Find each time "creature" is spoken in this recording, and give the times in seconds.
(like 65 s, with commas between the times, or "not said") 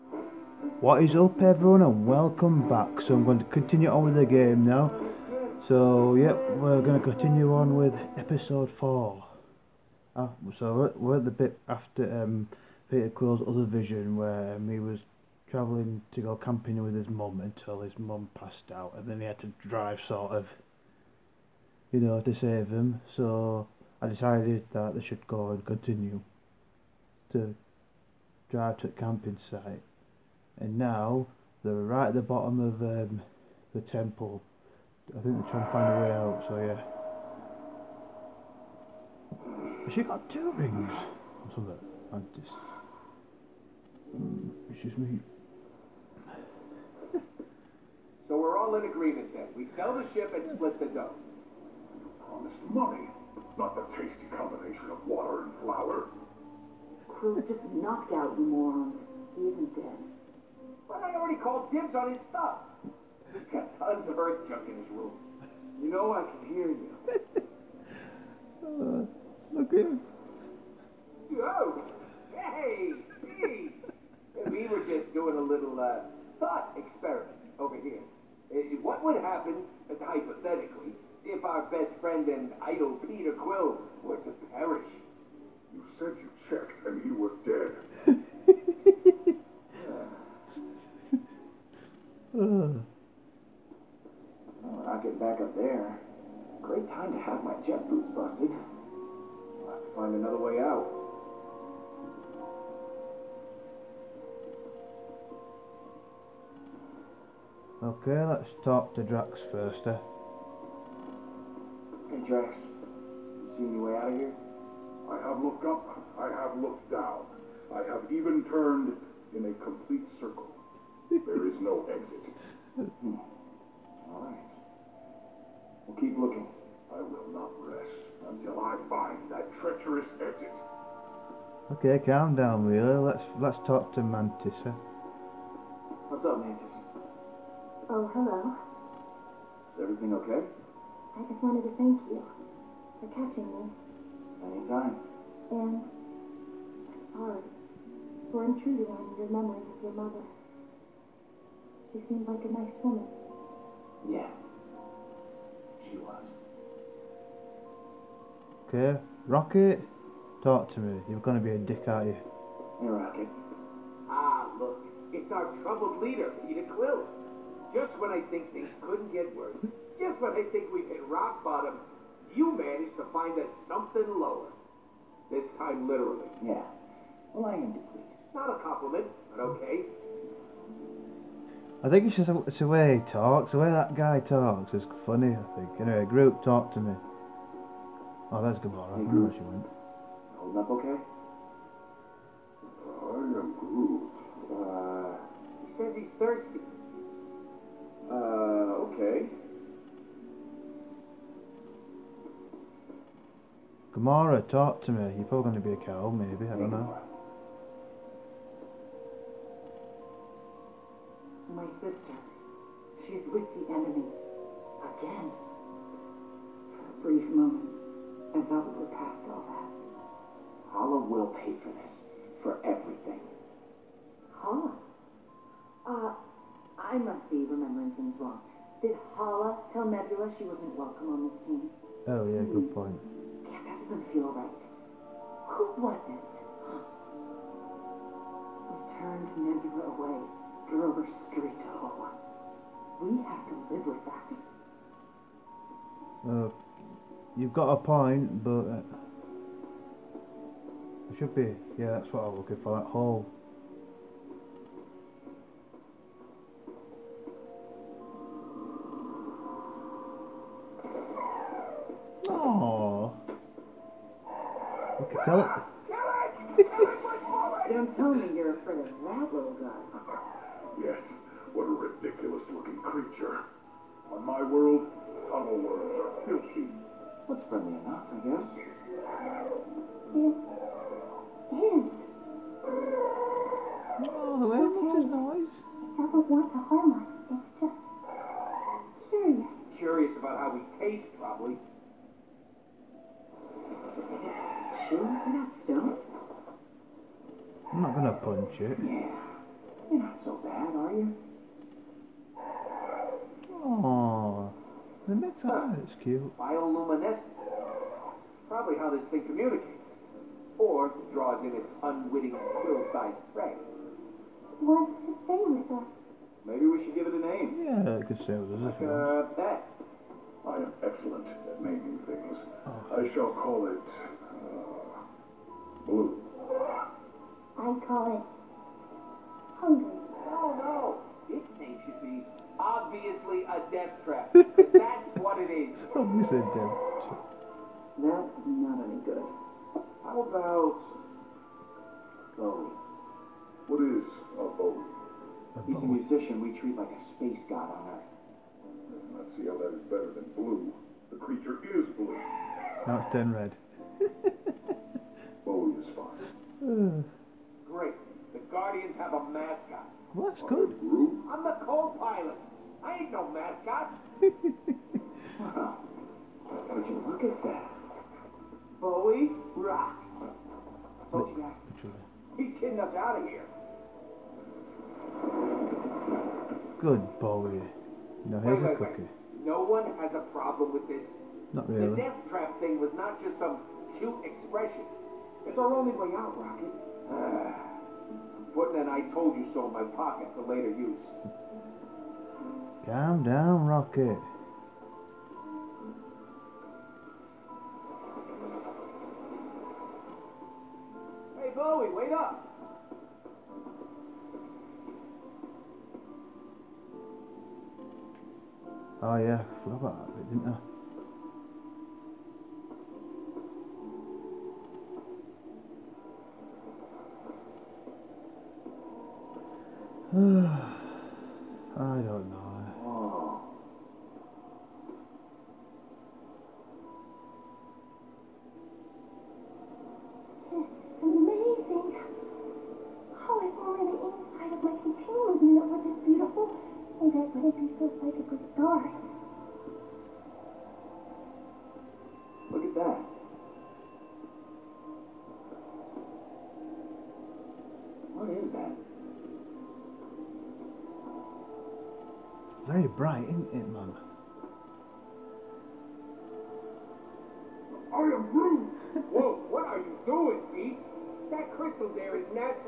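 272 s, 351 s.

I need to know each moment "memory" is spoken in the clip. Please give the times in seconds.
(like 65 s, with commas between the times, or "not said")
149 s.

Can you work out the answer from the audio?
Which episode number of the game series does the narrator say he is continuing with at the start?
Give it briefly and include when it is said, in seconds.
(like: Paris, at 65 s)
4, at 8 s.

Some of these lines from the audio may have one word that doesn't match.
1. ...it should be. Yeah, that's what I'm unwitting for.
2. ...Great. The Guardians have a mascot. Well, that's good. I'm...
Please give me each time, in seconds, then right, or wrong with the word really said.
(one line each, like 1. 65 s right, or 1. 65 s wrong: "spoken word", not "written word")
1. 251 s wrong: "looking", not "unwitting"
2. 357 s right.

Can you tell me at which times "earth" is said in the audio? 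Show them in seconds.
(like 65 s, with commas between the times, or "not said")
64 s, 347 s.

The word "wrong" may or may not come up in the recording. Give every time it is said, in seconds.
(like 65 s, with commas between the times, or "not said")
228 s.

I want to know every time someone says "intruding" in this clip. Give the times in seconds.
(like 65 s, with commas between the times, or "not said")
148 s.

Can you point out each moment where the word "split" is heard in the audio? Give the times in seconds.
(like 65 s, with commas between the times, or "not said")
50 s.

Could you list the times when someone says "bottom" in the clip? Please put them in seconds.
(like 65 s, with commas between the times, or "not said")
32 s, 171 s.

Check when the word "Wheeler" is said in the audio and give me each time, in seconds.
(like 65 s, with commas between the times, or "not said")
132 s.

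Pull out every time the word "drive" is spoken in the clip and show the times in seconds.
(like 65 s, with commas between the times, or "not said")
19 s, 28 s.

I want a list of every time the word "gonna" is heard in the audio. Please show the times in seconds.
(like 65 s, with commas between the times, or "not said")
297 s.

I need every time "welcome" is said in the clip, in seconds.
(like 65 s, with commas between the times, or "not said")
2 s, 230 s.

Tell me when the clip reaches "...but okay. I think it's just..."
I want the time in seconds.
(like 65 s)
179 s.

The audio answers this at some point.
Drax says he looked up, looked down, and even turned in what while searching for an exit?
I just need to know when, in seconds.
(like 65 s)
119 s.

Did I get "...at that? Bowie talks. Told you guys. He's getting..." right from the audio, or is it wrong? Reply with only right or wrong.
wrong.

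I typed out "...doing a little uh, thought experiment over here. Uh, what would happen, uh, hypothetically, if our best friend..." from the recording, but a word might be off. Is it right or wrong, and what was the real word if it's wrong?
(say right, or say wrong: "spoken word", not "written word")
right.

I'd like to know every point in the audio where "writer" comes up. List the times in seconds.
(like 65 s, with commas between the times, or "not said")
not said.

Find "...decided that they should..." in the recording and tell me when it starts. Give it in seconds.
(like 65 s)
24 s.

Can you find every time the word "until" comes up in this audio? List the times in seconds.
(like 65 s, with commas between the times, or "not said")
17 s, 128 s.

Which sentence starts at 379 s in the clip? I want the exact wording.
No one has a problem with this.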